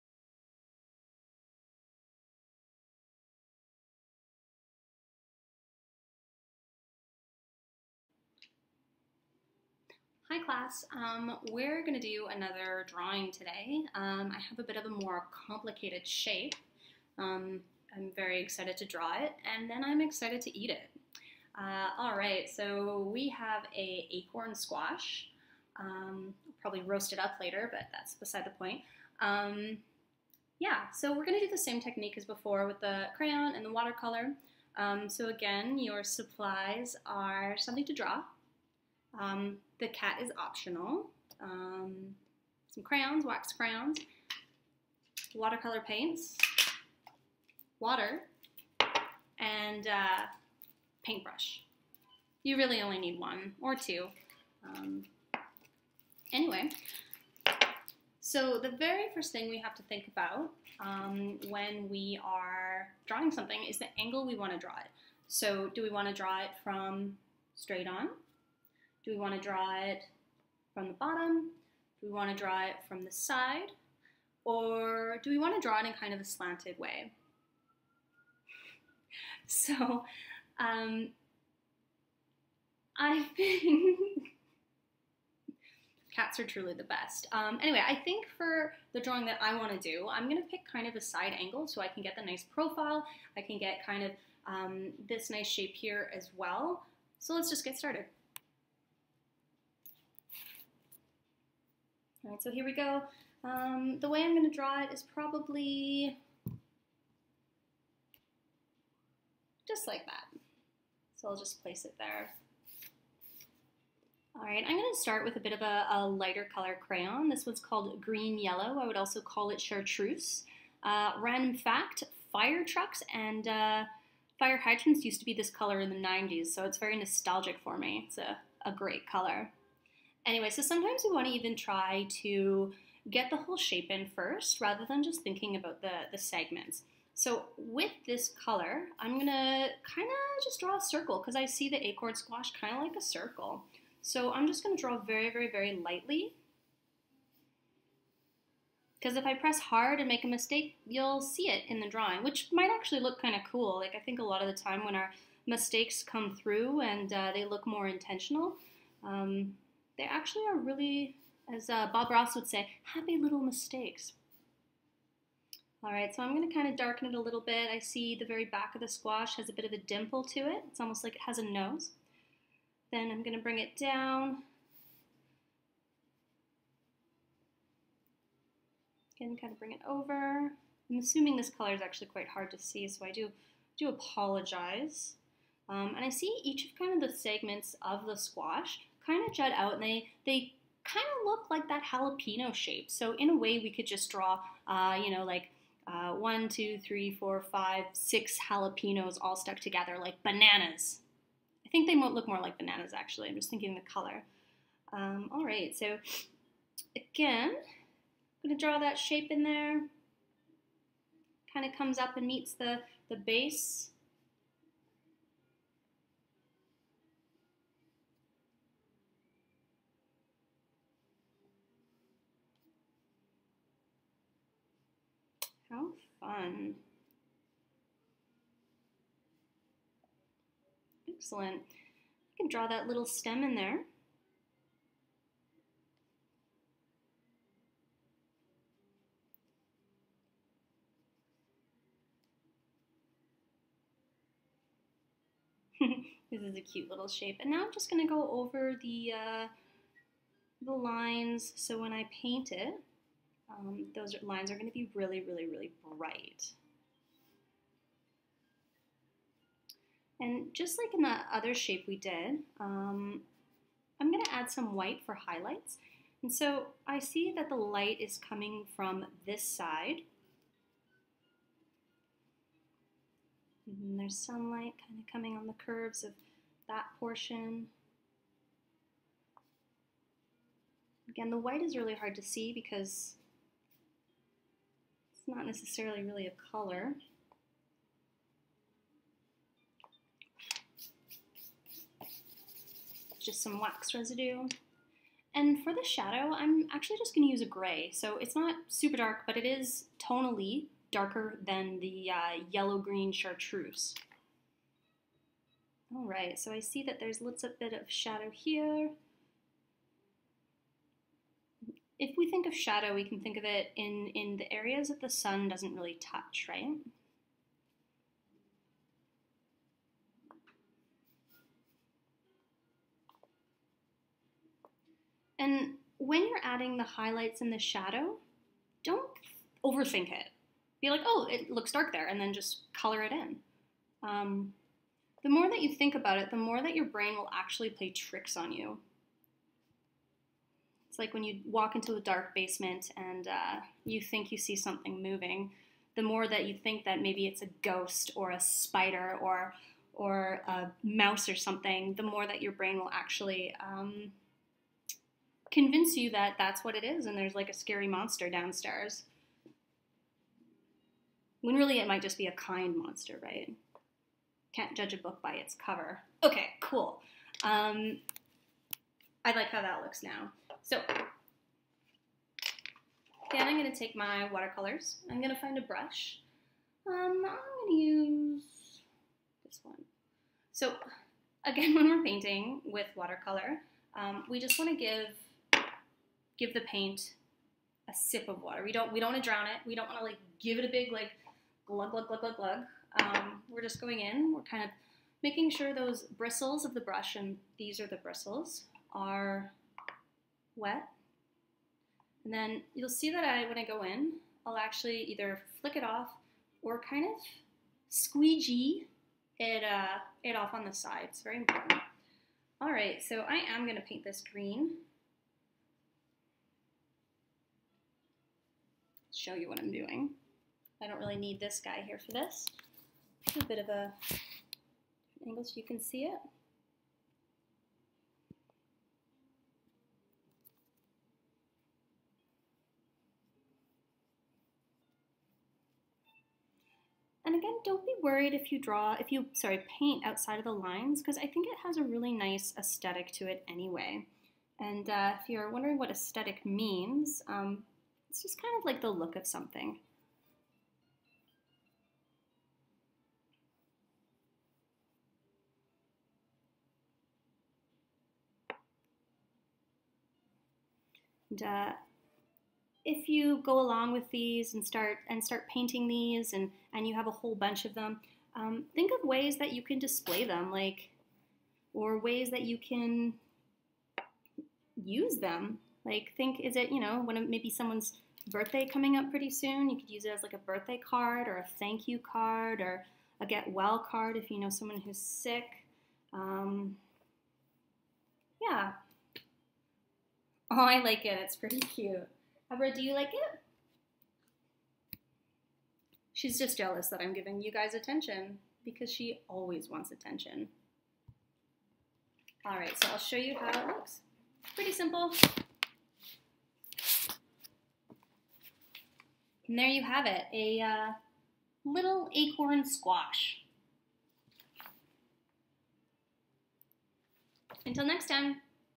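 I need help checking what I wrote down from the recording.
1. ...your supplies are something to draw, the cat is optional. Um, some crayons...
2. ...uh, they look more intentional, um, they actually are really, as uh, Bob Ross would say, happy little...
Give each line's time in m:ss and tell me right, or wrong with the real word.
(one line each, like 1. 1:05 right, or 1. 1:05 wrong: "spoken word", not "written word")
1. 0:35 right
2. 2:37 right.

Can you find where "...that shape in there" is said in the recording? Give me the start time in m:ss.
3:28.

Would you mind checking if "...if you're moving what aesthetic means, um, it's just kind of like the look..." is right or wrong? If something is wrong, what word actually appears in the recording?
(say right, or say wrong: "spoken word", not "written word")
wrong: "wondering", not "moving".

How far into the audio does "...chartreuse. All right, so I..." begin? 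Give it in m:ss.
5:03.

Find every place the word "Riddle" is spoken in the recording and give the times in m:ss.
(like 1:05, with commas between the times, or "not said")
not said.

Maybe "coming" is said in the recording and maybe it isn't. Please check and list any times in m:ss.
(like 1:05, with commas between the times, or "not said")
4:28, 4:35, 7:58.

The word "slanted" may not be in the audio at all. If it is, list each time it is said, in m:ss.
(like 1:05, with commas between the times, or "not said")
1:16.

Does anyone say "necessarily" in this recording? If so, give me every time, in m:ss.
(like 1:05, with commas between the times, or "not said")
4:45.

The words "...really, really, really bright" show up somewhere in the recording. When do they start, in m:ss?
4:14.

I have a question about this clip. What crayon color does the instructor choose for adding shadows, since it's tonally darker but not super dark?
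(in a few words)
Gray.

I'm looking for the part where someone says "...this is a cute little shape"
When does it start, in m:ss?
4:06.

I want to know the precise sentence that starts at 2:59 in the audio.
Again, kind of bring it over.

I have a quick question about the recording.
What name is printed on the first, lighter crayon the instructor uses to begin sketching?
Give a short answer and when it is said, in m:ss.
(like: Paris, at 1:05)
Green Yellow, at 1:58.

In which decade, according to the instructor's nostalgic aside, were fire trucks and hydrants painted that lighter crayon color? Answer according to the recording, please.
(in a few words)
The 90s.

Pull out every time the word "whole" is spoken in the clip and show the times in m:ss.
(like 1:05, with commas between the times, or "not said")
2:13, 7:47.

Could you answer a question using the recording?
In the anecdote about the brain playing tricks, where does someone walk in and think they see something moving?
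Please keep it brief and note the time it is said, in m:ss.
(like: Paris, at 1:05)
A dark basement, at 5:42.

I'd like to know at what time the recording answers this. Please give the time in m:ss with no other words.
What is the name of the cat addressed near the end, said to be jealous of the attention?
8:12.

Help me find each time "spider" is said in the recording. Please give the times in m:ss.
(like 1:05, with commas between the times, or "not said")
5:48.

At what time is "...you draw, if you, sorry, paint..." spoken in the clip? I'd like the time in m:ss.
7:18.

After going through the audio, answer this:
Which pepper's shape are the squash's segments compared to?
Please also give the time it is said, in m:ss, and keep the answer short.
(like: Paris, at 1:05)
Jalapeno, at 3:11.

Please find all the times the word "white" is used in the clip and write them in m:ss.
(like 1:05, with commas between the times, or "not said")
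4:24, 4:41.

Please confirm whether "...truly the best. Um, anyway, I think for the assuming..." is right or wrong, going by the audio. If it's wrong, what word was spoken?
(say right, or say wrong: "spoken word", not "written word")
wrong: "drawing", not "assuming".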